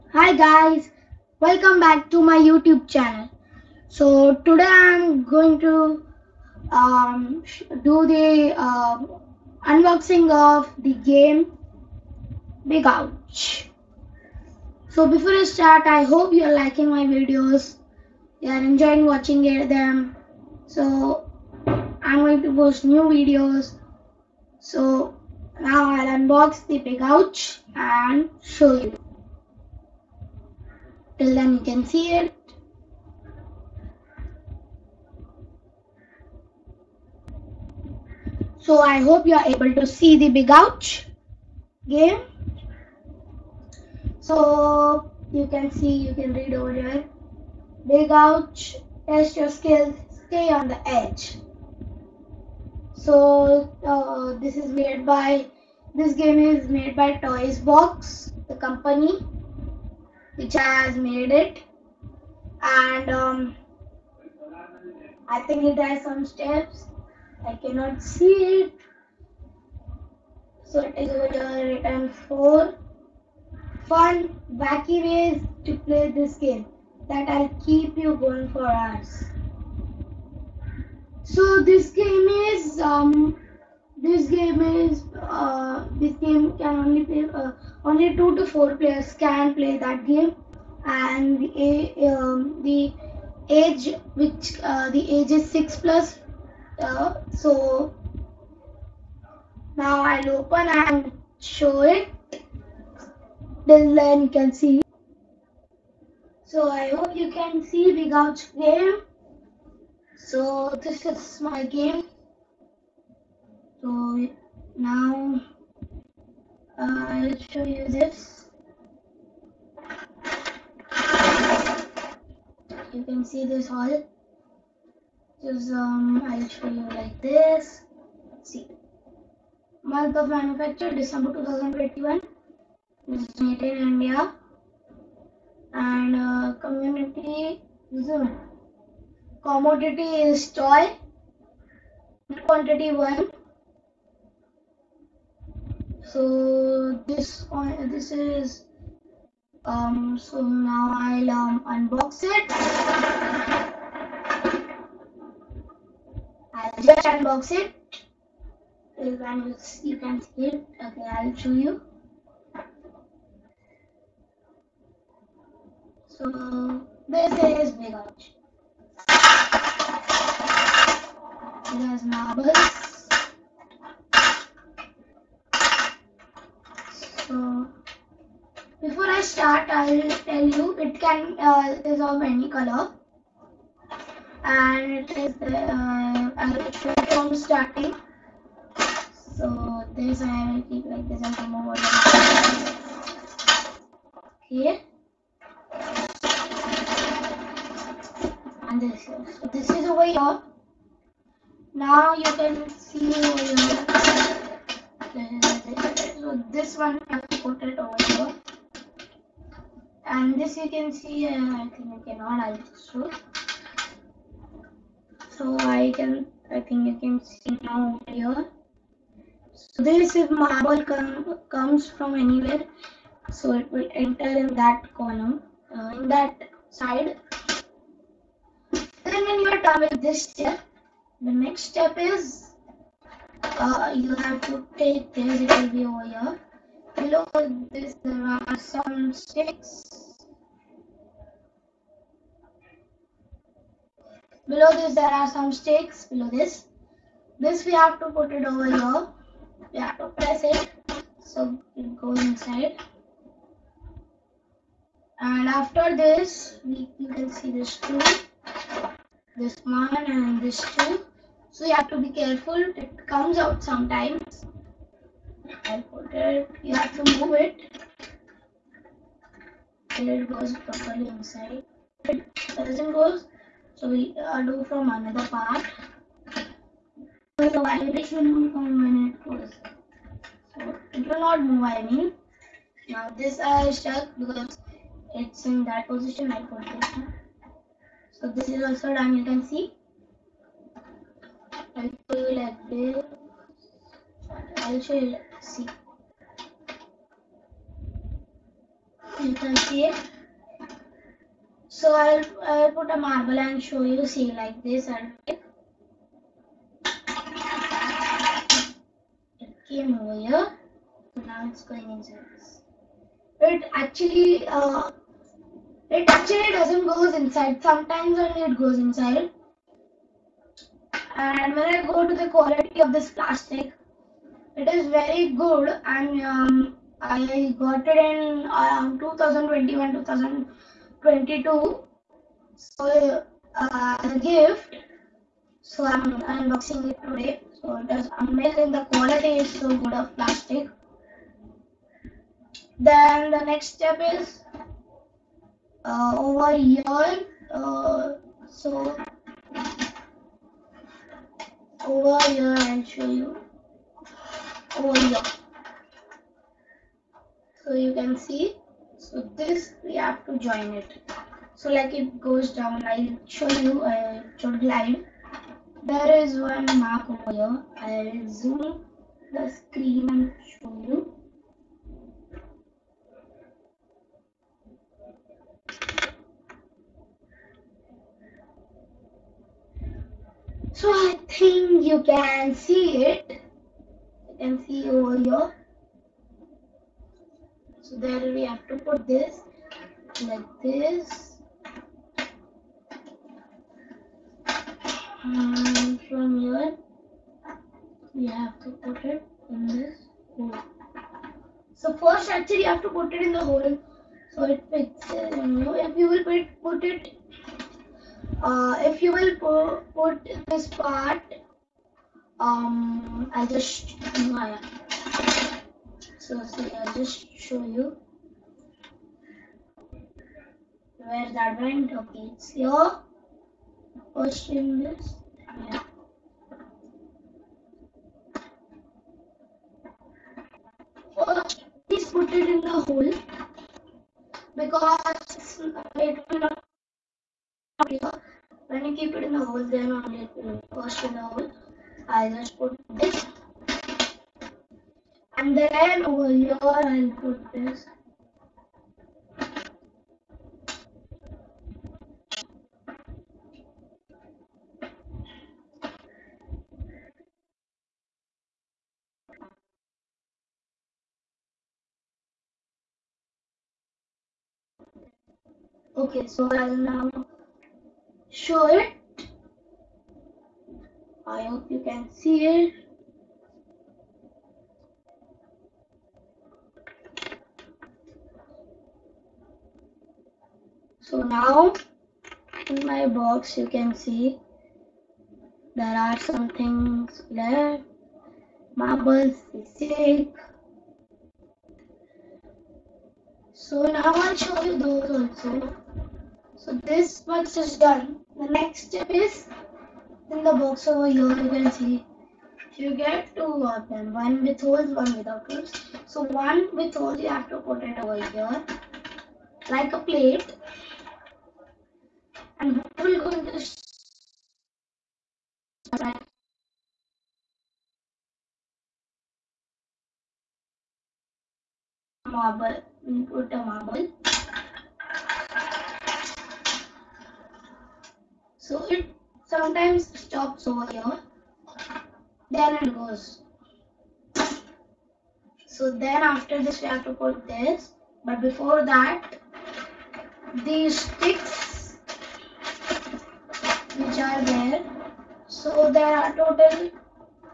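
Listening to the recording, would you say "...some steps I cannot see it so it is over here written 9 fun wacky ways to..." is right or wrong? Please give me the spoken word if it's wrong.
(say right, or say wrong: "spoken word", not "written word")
wrong: "4", not "9".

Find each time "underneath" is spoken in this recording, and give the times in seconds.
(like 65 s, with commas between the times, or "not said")
not said.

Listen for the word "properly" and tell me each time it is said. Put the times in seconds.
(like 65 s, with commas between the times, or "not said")
270 s.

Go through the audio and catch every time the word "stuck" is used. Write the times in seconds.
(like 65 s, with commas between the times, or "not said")
283 s.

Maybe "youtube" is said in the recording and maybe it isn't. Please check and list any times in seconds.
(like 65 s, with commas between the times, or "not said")
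2 s.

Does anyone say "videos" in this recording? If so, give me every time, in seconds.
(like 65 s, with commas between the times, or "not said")
17 s, 23 s.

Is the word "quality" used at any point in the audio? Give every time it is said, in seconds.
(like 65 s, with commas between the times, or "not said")
322 s, 338 s.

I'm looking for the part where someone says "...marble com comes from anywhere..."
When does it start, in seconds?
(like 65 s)
220 s.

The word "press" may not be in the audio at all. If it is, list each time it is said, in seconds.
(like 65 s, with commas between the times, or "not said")
250 s.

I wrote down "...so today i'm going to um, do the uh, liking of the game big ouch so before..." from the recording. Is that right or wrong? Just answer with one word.
wrong.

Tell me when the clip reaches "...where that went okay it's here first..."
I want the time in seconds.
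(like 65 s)
420 s.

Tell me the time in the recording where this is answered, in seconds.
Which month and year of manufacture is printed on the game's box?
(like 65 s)
130 s.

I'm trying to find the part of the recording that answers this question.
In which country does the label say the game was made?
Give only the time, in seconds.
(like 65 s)
133 s.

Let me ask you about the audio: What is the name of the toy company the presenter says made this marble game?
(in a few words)
Toys Box.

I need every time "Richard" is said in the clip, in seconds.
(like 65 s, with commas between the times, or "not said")
not said.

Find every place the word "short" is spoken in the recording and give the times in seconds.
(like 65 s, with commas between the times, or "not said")
364 s.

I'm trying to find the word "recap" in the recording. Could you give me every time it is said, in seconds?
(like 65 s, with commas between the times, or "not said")
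not said.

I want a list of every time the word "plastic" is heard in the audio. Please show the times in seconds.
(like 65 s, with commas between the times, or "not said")
323 s, 340 s.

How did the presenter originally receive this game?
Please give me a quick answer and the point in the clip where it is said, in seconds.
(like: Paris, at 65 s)
As a gift, at 334 s.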